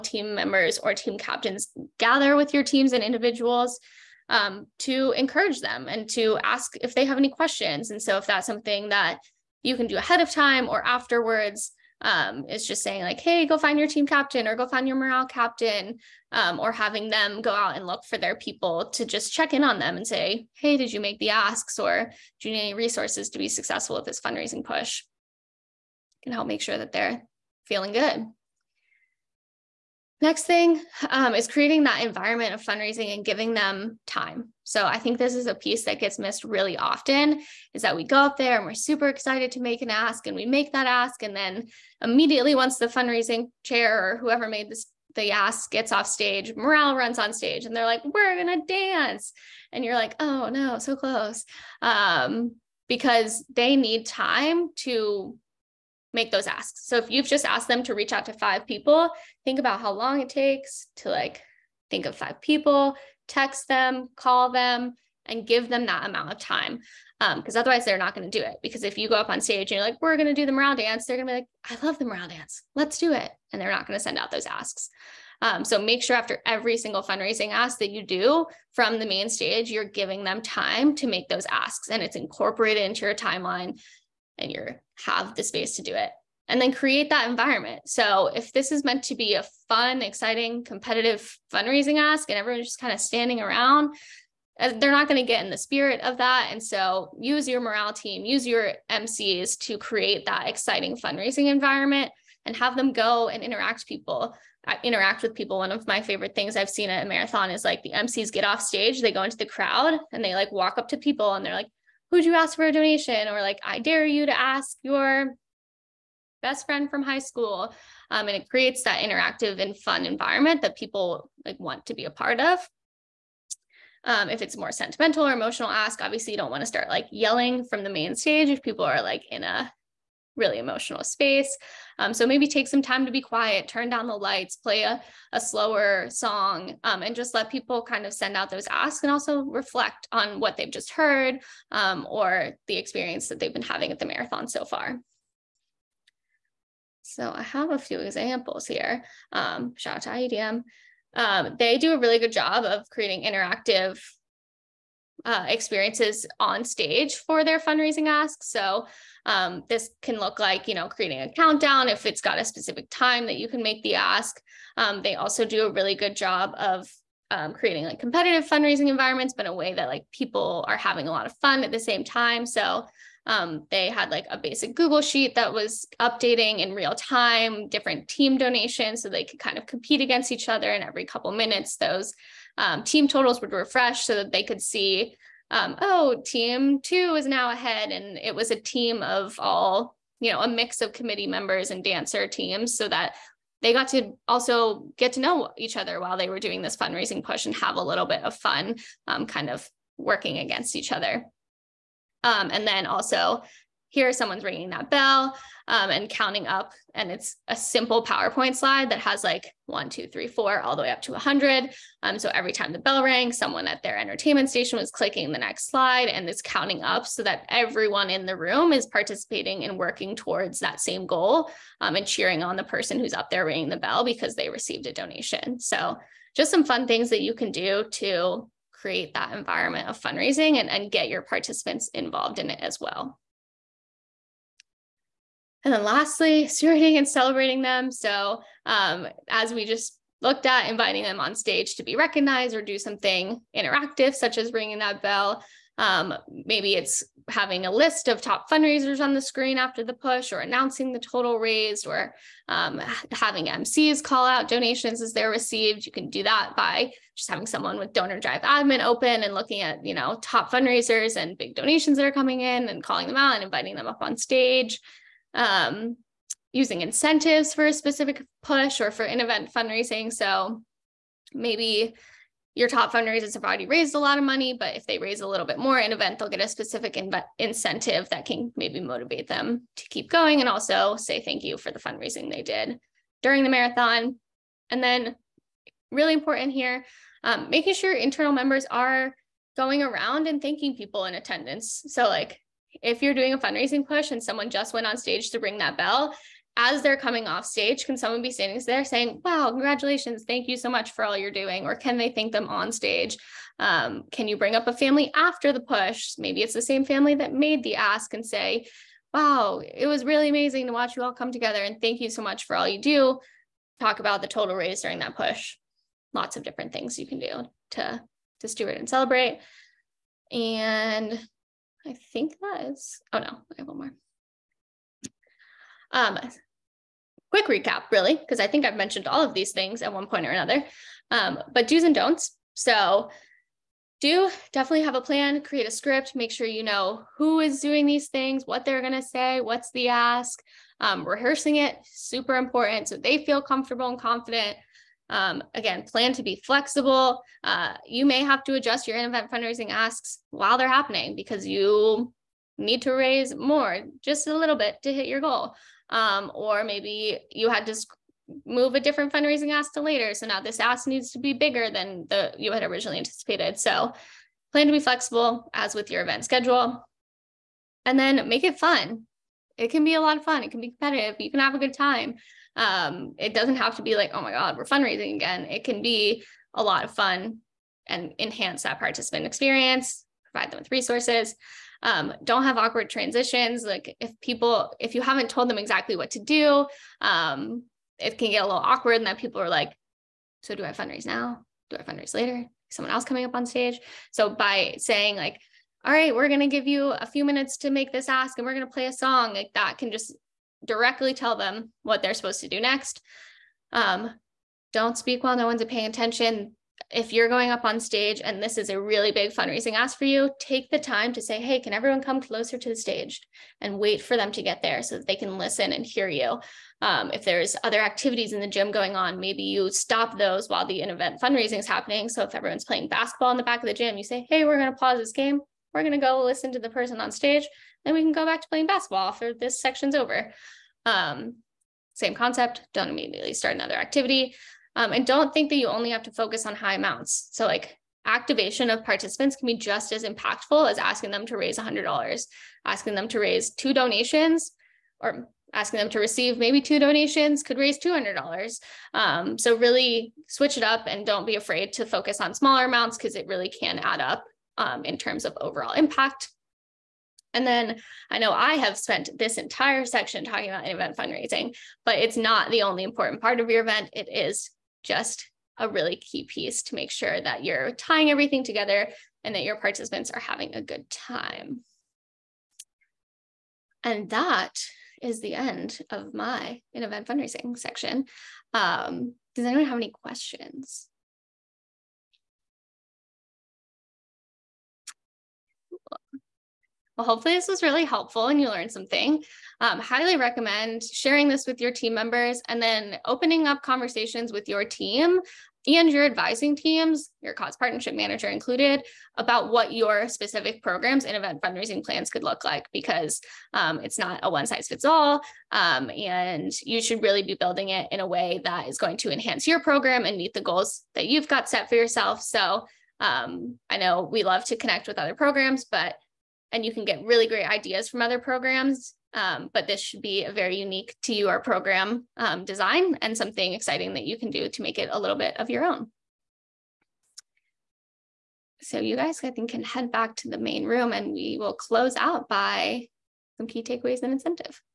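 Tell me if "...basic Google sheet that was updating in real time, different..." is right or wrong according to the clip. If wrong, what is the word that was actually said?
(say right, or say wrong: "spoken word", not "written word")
right.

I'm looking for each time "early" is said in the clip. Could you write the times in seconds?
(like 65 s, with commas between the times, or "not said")
not said.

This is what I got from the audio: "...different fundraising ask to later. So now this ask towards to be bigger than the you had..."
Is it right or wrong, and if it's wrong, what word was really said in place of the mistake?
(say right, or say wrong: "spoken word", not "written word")
wrong: "needs", not "towards".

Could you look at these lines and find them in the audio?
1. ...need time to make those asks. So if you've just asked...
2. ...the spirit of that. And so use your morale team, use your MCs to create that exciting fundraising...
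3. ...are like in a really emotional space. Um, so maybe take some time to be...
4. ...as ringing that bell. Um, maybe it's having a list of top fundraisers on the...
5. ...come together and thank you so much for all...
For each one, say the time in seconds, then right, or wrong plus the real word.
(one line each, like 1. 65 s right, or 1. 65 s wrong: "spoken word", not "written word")
1. 53 s right
2. 95 s right
3. 128 s right
4. 244 s right
5. 311 s right.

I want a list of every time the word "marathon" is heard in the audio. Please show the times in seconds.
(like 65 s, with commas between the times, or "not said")
107 s, 144 s, 283 s.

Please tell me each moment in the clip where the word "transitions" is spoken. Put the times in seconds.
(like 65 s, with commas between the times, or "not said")
382 s.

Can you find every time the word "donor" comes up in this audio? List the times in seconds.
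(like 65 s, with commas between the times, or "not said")
257 s.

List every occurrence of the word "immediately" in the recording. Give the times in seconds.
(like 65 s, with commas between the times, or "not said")
42 s, 432 s.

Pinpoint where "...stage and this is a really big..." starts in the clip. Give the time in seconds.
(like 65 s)
407 s.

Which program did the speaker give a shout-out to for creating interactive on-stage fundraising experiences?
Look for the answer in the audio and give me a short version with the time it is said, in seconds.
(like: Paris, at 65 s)
IEDM, at 150 s.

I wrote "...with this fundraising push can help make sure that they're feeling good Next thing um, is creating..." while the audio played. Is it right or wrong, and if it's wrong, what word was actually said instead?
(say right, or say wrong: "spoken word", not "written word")
right.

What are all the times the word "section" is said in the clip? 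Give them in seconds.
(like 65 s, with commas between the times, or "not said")
429 s, 459 s, 477 s.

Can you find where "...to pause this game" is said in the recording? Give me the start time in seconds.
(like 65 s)
424 s.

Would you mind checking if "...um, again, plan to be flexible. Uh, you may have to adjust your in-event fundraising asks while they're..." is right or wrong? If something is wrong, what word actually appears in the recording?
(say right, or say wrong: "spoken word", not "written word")
right.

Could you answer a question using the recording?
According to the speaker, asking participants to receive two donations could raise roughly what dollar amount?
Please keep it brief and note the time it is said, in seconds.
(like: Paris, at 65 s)
$200, at 447 s.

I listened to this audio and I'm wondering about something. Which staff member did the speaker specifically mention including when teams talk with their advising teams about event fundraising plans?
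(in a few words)
Cause partnership manager.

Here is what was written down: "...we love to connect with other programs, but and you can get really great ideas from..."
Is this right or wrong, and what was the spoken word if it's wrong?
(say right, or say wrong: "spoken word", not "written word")
right.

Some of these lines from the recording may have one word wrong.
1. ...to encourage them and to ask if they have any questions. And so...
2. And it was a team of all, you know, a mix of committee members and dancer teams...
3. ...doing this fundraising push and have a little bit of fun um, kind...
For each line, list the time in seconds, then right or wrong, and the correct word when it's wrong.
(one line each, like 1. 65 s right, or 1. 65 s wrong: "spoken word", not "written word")
1. 4 s right
2. 187 s right
3. 196 s right.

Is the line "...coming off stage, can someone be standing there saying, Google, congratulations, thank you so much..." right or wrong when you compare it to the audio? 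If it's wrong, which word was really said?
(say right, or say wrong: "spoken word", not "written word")
wrong: "Wow", not "Google".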